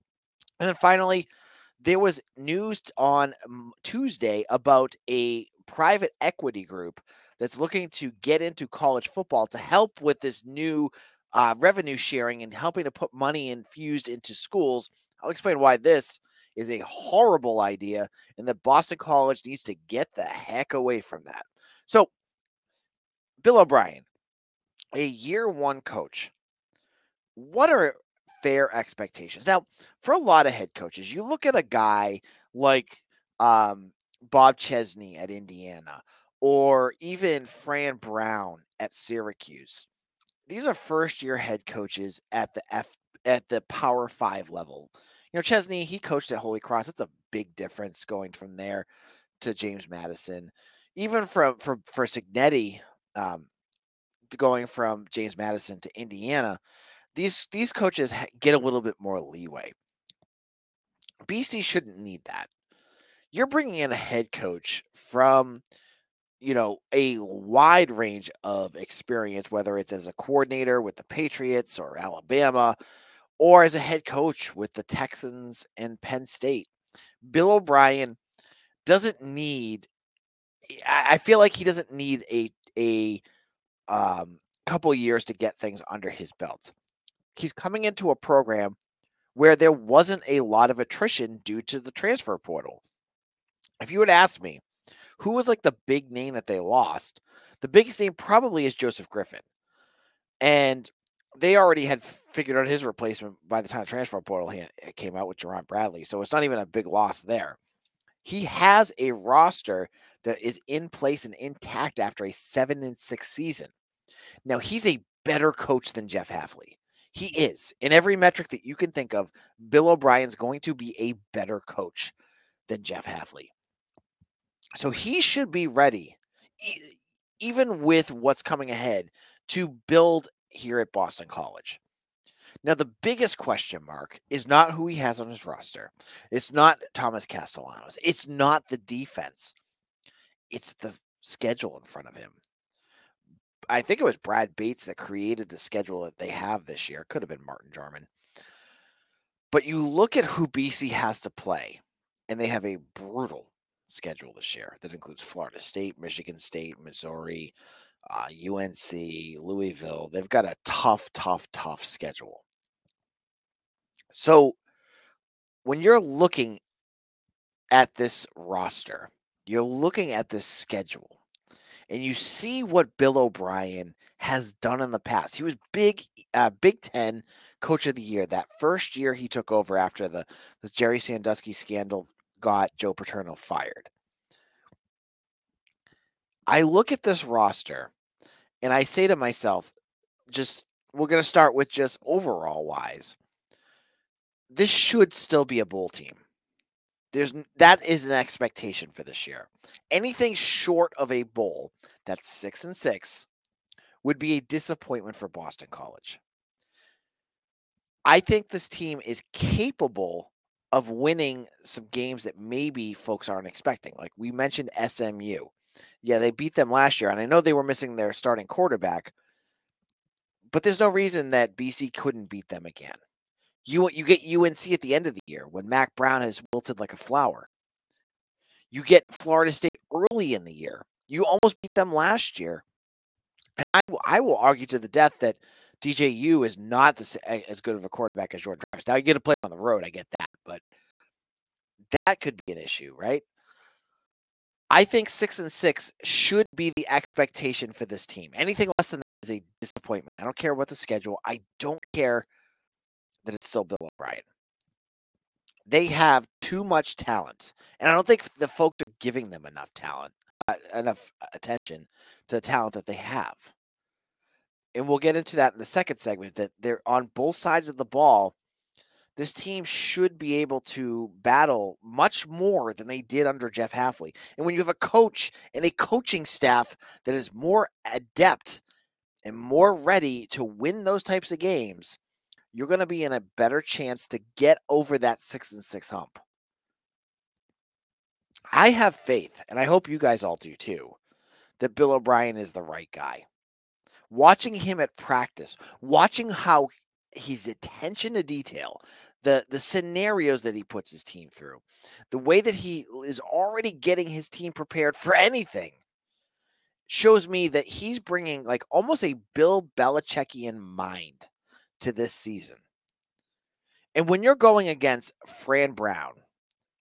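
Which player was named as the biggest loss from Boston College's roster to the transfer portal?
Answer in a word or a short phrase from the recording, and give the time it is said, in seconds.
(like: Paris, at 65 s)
Joseph Griffin, at 98 s.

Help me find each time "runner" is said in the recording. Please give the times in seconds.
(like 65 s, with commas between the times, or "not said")
not said.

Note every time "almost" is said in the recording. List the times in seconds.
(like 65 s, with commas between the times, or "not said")
231 s, 308 s.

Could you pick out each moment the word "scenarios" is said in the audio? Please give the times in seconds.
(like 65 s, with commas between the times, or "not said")
299 s.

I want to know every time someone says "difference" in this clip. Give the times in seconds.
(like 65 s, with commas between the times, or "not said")
47 s.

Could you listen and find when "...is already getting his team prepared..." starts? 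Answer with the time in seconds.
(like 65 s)
303 s.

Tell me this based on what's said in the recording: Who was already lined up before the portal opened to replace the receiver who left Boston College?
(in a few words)
Jerand Bradley.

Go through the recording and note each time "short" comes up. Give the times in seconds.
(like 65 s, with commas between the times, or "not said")
200 s.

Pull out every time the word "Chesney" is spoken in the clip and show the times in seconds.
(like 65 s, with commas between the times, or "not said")
34 s, 45 s.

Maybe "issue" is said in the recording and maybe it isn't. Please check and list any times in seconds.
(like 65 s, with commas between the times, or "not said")
242 s.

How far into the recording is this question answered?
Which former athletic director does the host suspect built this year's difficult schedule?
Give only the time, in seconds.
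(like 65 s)
144 s.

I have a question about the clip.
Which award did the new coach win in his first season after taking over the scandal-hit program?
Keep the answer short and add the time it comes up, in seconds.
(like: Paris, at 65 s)
Big Ten Coach of the Year, at 176 s.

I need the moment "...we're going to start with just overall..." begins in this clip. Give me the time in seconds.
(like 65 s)
190 s.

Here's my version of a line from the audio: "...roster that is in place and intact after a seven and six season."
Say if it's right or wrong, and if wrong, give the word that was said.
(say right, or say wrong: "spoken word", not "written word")
right.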